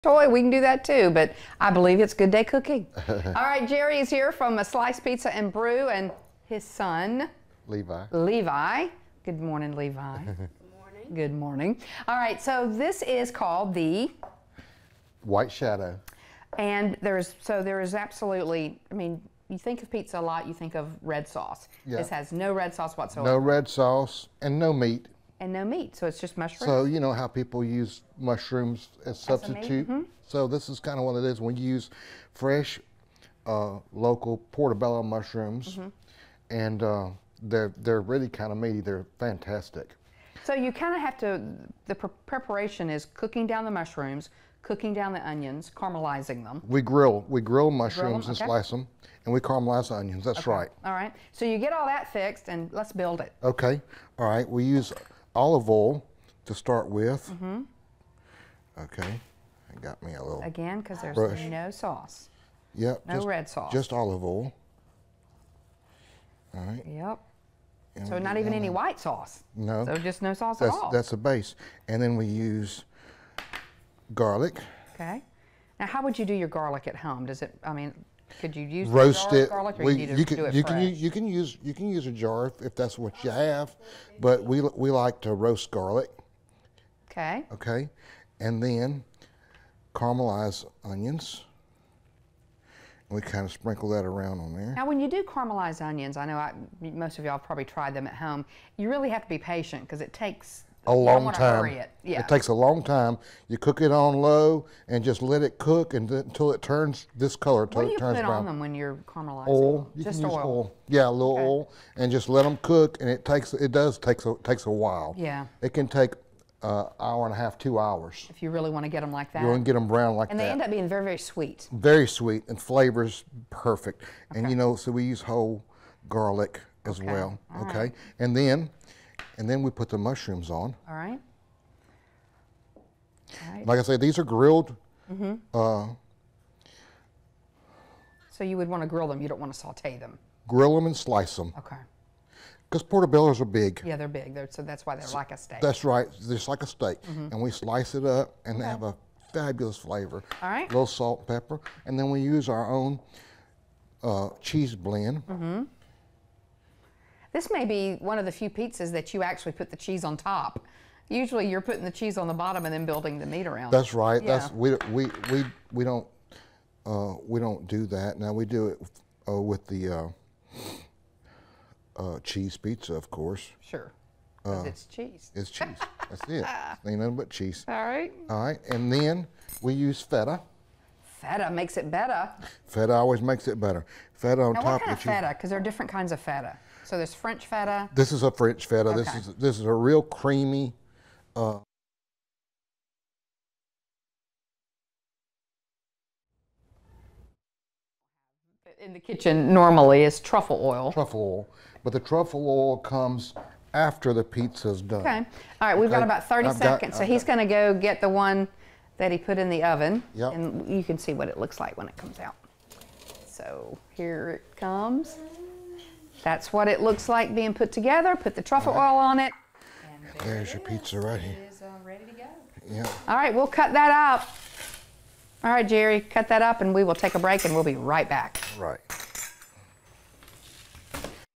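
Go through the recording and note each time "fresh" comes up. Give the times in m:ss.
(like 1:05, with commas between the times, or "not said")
0:32.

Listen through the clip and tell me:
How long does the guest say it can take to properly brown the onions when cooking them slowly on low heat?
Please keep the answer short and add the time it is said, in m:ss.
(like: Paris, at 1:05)
hour and a half, two hours, at 1:56.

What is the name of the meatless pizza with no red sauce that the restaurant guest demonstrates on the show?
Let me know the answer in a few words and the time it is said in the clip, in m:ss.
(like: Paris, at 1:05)
White Shadow, at 0:15.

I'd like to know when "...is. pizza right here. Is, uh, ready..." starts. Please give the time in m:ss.
3:40.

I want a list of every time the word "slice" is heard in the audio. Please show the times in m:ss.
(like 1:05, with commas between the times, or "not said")
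0:04, 0:48, 2:20, 2:27.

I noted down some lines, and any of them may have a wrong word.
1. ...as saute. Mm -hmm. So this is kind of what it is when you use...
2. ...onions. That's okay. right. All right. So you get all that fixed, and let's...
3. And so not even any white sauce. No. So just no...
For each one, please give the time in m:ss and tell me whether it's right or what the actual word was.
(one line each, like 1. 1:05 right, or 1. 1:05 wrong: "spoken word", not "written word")
1. 0:29 wrong: "substitute", not "saute"
2. 0:50 right
3. 1:07 right.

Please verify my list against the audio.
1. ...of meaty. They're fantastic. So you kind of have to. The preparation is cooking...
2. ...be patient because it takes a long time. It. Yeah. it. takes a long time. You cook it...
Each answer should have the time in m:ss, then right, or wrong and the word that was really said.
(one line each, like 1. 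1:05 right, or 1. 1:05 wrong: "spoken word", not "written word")
1. 0:38 right
2. 1:39 right.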